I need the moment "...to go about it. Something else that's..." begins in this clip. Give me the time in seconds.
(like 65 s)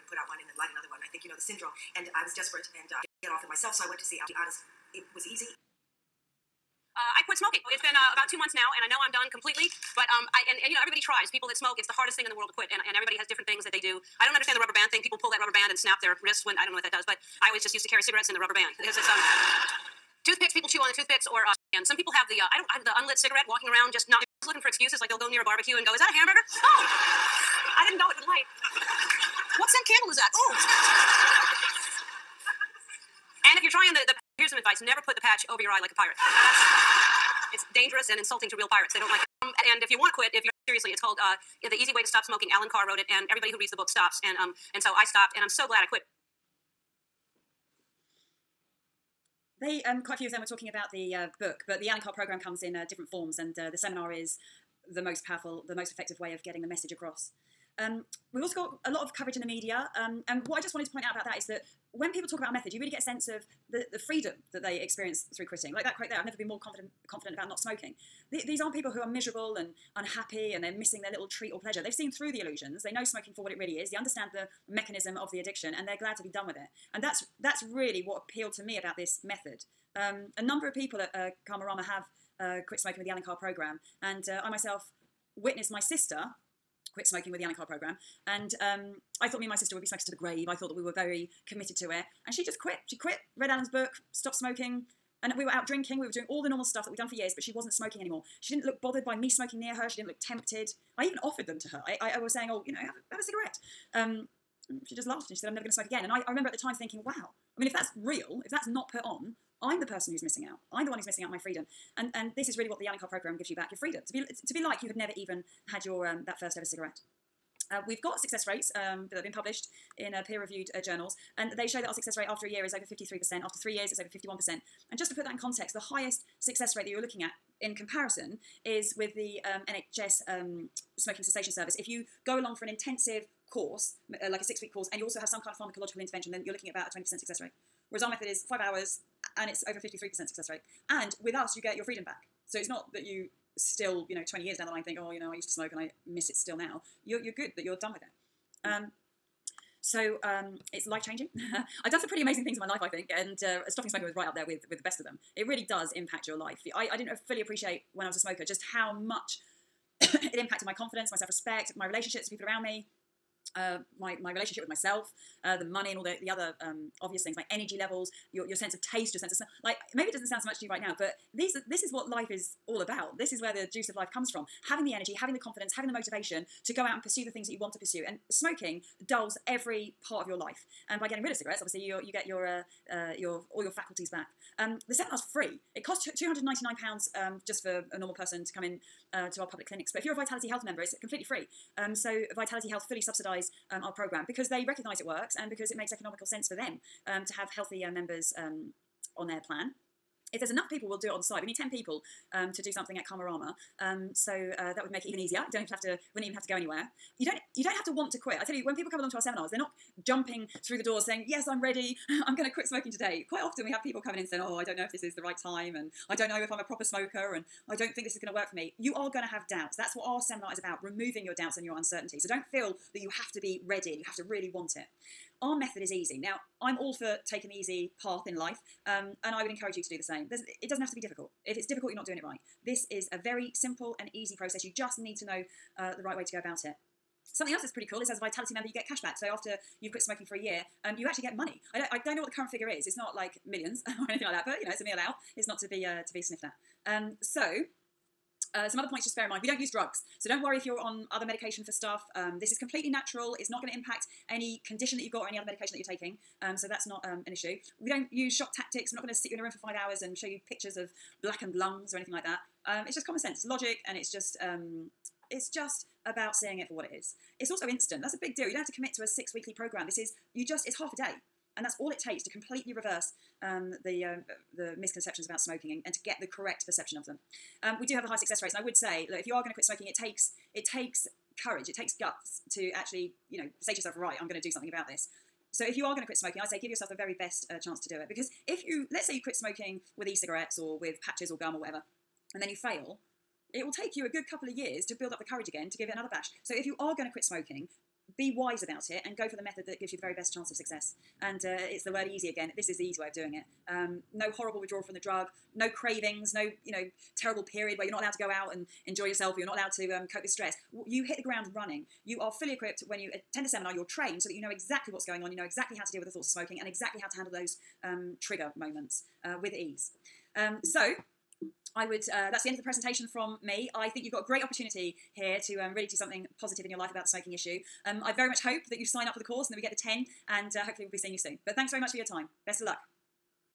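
236 s.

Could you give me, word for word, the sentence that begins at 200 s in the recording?
If there's enough people, we'll do it on site.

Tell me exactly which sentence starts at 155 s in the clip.
It really does impact your life.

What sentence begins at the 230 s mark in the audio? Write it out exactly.
There's, it doesn't have to be difficult.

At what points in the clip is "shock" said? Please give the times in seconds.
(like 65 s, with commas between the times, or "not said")
258 s.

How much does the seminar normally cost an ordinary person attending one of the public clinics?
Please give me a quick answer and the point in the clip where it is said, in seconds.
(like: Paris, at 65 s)
£299, at 186 s.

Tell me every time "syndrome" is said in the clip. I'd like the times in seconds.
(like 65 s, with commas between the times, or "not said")
1 s.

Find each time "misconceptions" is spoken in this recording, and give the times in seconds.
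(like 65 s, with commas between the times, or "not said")
274 s.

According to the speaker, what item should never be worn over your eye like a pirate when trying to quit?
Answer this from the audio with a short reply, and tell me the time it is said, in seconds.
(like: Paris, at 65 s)
the patch, at 35 s.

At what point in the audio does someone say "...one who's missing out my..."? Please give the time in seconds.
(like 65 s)
110 s.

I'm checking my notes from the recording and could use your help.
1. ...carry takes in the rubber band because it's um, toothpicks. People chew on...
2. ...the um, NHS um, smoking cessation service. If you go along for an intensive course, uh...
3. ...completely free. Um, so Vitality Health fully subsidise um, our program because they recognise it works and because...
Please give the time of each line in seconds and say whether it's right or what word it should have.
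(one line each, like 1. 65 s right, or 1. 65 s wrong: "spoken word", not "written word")
1. 17 s wrong: "cigarettes", not "takes"
2. 129 s right
3. 191 s right.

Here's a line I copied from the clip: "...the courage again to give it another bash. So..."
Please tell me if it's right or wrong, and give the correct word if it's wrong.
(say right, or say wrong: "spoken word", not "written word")
right.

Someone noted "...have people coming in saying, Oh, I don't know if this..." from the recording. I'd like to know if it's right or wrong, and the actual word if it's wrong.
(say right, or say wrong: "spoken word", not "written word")
right.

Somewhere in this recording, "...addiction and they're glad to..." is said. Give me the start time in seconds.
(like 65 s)
75 s.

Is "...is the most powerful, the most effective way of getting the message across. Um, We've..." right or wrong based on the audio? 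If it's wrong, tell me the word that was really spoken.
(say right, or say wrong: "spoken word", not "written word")
right.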